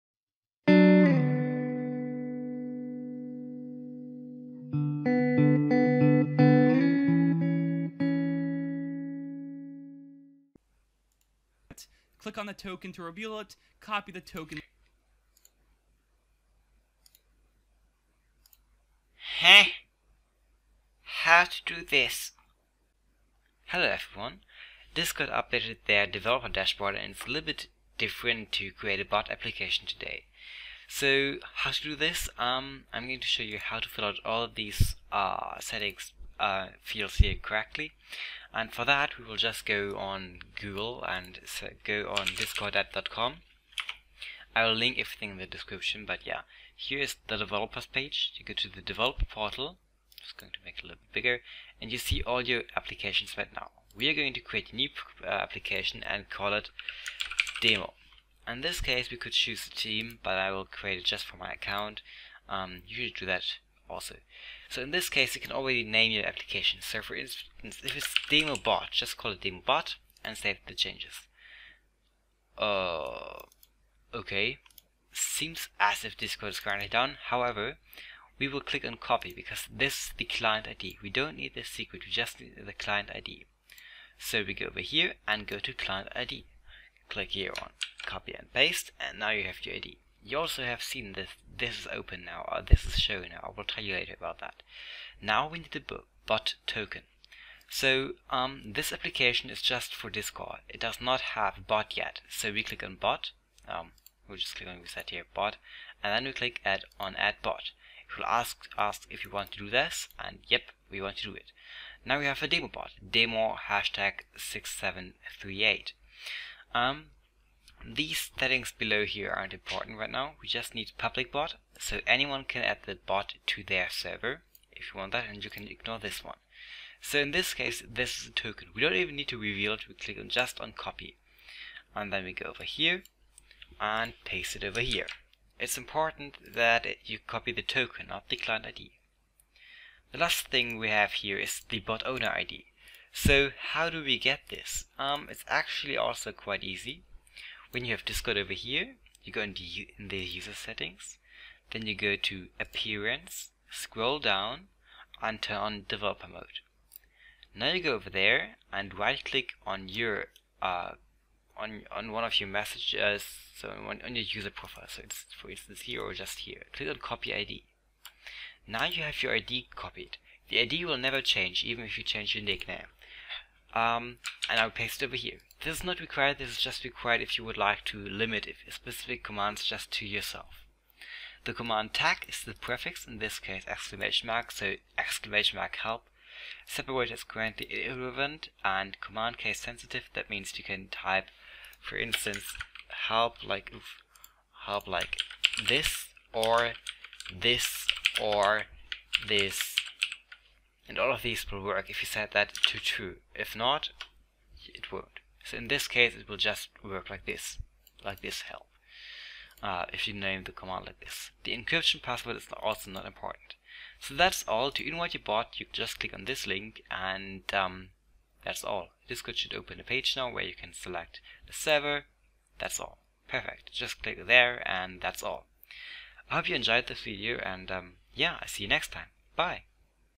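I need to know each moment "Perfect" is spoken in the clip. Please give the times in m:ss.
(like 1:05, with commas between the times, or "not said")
3:43.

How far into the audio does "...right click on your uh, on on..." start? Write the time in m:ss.
2:38.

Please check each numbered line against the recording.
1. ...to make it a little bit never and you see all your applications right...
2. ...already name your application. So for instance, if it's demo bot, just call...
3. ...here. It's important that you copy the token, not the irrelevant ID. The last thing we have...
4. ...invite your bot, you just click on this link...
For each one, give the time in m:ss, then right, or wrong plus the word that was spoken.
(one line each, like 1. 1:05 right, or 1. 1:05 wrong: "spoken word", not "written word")
1. 0:50 wrong: "bigger", not "never"
2. 1:05 right
3. 2:14 wrong: "client", not "irrelevant"
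4. 3:34 right.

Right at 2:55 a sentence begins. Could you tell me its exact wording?
This is not required, this is just required if you would like to limit specific commands just to yourself.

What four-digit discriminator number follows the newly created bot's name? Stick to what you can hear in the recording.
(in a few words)
6738.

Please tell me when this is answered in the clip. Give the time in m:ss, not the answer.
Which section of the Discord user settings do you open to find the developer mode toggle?
2:32.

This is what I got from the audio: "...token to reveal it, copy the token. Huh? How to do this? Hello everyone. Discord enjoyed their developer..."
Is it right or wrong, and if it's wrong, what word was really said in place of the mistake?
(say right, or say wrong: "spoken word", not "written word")
wrong: "updated", not "enjoyed".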